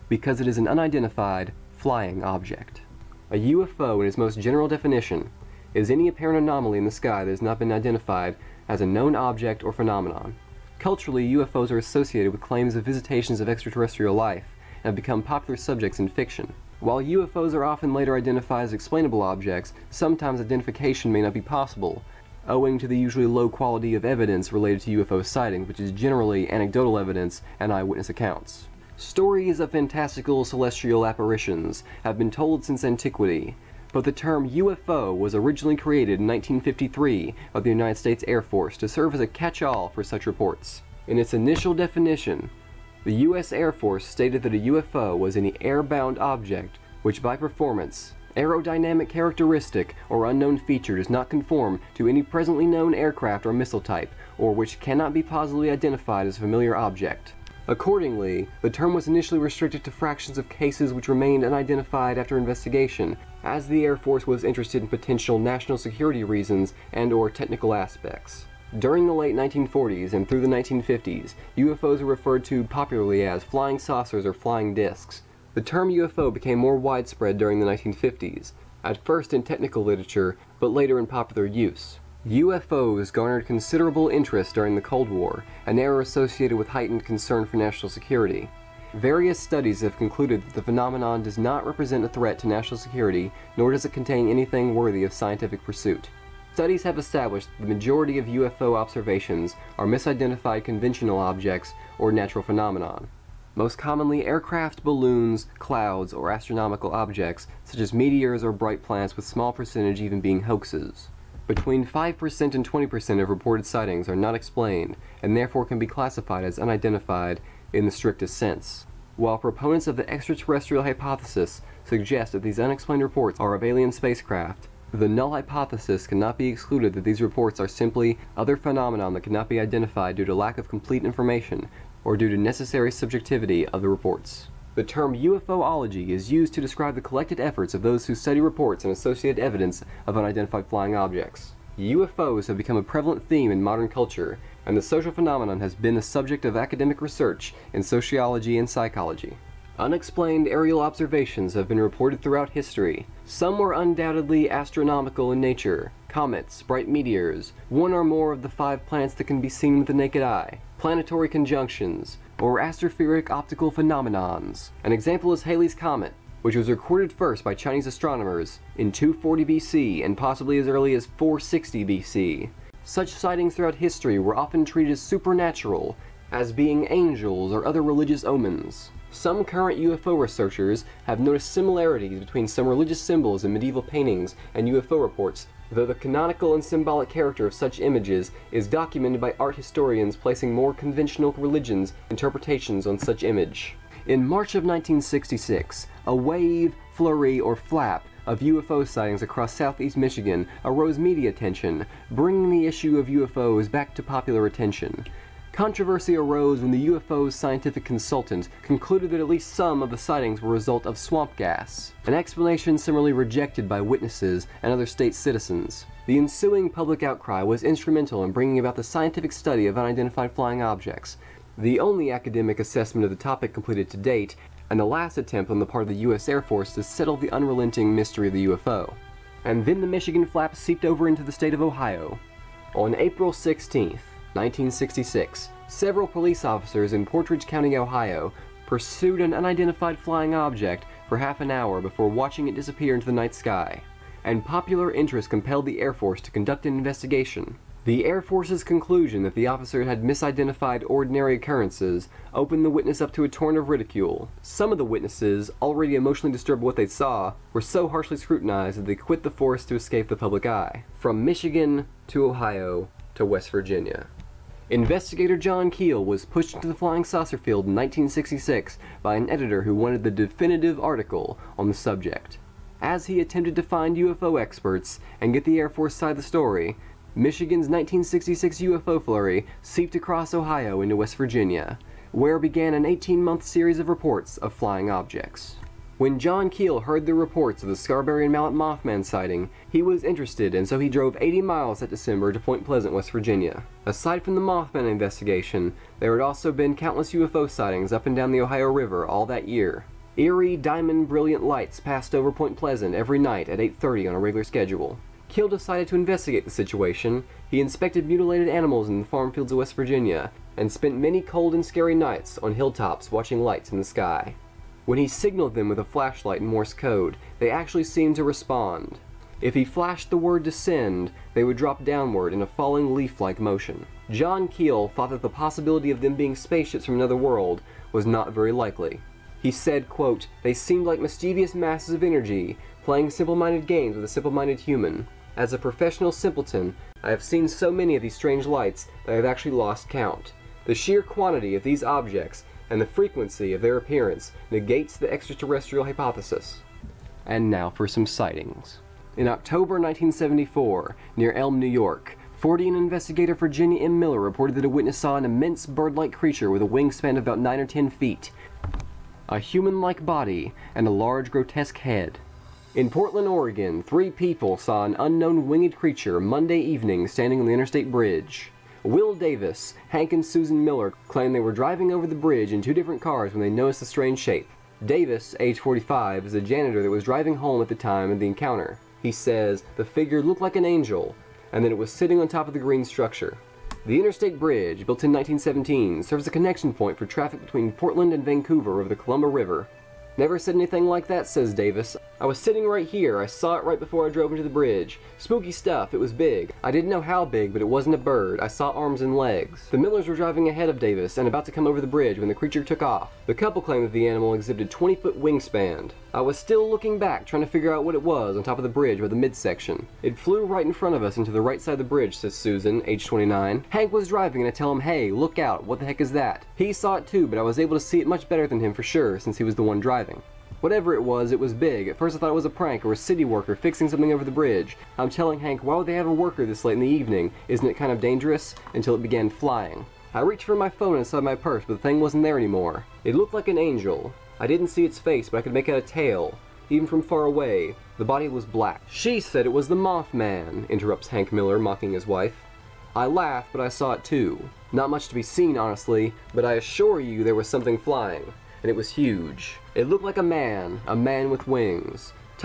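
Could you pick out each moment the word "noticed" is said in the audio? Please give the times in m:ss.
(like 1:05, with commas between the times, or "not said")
3:01, 6:13.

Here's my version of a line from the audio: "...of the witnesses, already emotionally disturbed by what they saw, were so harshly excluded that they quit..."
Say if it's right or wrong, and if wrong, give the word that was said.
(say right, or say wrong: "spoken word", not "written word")
wrong: "scrutinized", not "excluded".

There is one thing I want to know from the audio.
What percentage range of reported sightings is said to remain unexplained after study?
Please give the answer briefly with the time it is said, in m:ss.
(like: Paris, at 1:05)
5% to 20%, at 1:51.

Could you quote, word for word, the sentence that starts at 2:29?
Unexplained aerial observations have been reported throughout history.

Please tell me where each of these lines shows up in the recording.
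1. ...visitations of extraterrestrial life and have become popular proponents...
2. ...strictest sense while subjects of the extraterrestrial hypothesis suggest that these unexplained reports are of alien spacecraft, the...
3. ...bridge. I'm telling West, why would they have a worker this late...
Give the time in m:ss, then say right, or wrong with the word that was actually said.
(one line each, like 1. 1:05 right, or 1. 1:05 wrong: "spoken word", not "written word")
1. 0:12 wrong: "subjects", not "proponents"
2. 1:57 wrong: "proponents", not "subjects"
3. 7:04 wrong: "Hank", not "West".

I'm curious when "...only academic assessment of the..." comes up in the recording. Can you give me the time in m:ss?
3:41.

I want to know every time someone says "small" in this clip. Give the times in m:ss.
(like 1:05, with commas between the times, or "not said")
1:49.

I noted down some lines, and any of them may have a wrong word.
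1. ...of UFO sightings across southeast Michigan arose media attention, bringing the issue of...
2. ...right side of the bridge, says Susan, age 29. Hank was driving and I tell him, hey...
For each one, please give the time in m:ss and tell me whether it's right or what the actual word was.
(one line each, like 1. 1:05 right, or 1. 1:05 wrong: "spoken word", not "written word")
1. 3:18 right
2. 6:51 right.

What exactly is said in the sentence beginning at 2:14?
The term UFOlogy is used to describe the collected efforts of those who study reports and associated evidence of unidentified flying objects.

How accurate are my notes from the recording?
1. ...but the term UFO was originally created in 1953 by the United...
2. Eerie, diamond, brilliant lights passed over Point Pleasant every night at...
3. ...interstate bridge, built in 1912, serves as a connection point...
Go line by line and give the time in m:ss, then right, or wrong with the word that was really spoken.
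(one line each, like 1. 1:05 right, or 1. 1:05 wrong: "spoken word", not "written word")
1. 0:33 right
2. 5:00 right
3. 6:23 wrong: "1917", not "1912".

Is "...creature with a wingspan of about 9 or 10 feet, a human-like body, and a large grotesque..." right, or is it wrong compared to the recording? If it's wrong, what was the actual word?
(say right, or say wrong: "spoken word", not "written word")
right.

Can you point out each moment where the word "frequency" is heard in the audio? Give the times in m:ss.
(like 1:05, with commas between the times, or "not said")
5:42.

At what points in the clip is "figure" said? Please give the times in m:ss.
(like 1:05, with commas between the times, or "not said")
6:19, 6:47.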